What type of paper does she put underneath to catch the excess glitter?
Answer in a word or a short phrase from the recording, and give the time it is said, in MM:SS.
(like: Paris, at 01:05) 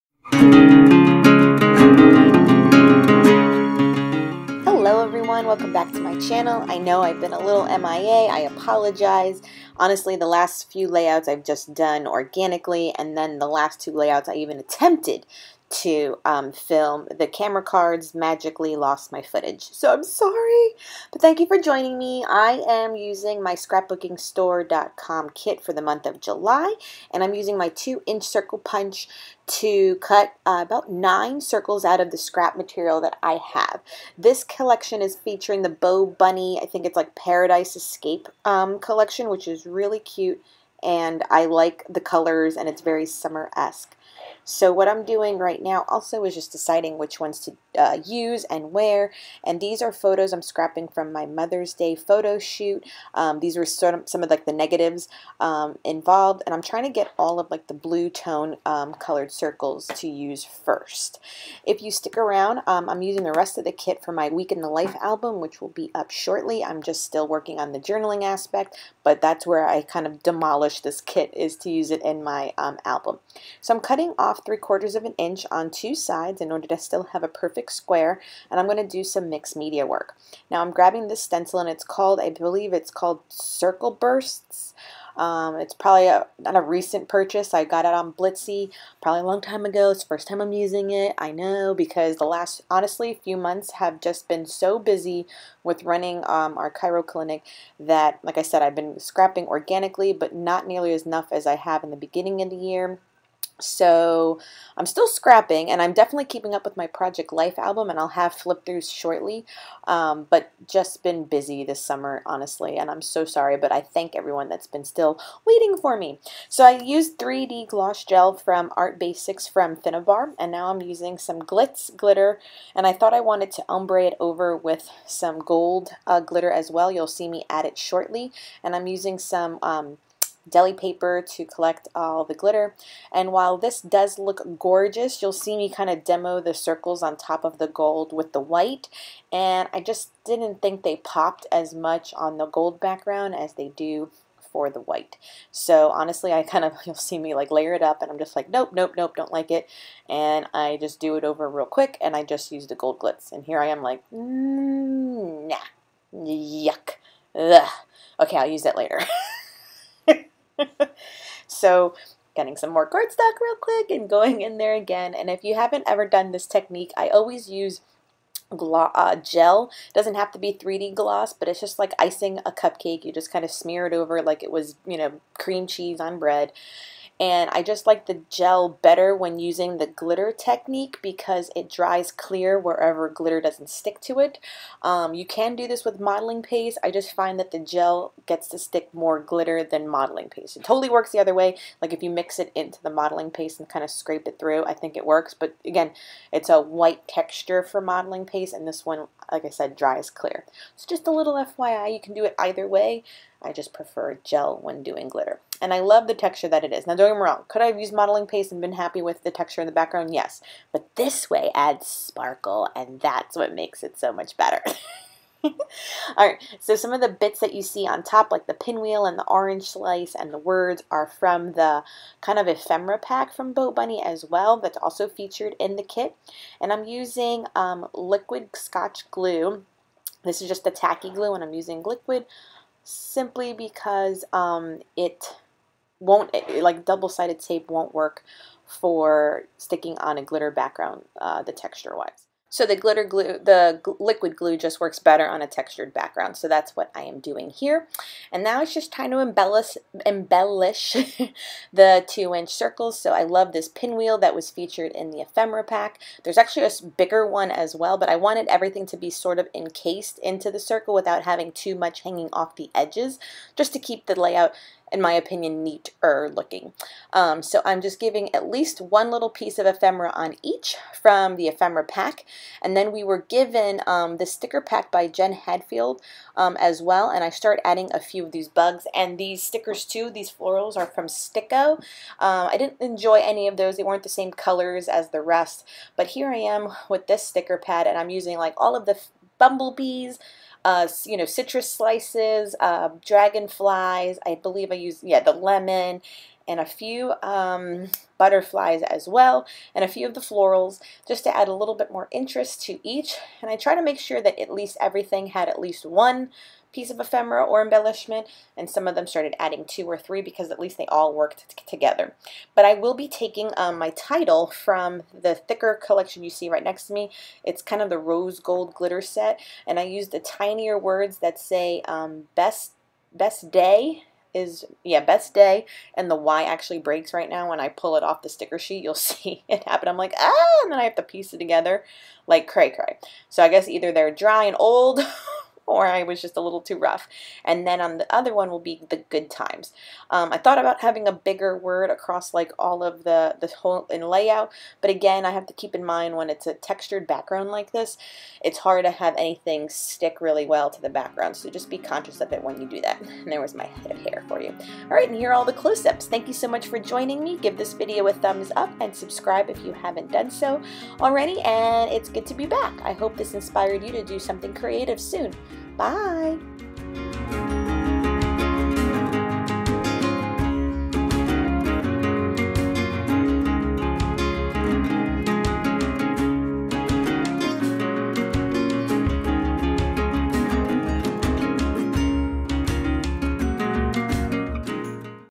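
deli paper, at 02:10.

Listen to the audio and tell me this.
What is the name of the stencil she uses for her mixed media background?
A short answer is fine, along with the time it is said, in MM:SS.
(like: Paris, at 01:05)
Circle Bursts, at 01:23.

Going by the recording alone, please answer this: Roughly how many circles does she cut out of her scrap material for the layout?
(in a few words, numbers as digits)
9.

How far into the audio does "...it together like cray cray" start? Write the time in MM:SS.
05:31.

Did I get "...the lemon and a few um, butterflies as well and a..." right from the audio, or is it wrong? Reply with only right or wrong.
right.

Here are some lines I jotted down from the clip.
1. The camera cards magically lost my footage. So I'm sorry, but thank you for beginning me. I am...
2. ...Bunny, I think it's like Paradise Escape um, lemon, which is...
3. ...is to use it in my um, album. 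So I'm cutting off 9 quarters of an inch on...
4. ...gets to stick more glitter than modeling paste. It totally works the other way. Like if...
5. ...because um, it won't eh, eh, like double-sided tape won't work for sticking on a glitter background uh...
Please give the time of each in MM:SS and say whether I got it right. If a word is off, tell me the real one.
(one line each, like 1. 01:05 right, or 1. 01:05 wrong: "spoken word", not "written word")
1. 00:17 wrong: "joining", not "beginning"
2. 00:36 wrong: "collection", not "lemon"
3. 01:11 wrong: "3", not "9"
4. 03:08 right
5. 03:53 right.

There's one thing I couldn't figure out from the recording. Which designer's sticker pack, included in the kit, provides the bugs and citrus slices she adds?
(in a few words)
Jen Hadfield.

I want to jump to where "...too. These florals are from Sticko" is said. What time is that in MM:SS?
04:39.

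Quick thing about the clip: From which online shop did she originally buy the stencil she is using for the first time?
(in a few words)
Blitsy.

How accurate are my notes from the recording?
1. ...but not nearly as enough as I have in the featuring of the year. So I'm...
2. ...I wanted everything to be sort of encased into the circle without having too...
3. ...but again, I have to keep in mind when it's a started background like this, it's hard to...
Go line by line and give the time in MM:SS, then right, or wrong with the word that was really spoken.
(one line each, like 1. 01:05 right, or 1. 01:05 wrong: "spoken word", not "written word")
1. 01:40 wrong: "beginning", not "featuring"
2. 04:18 right
3. 05:44 wrong: "textured", not "started".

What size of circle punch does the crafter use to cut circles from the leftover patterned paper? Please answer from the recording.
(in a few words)
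2 inch.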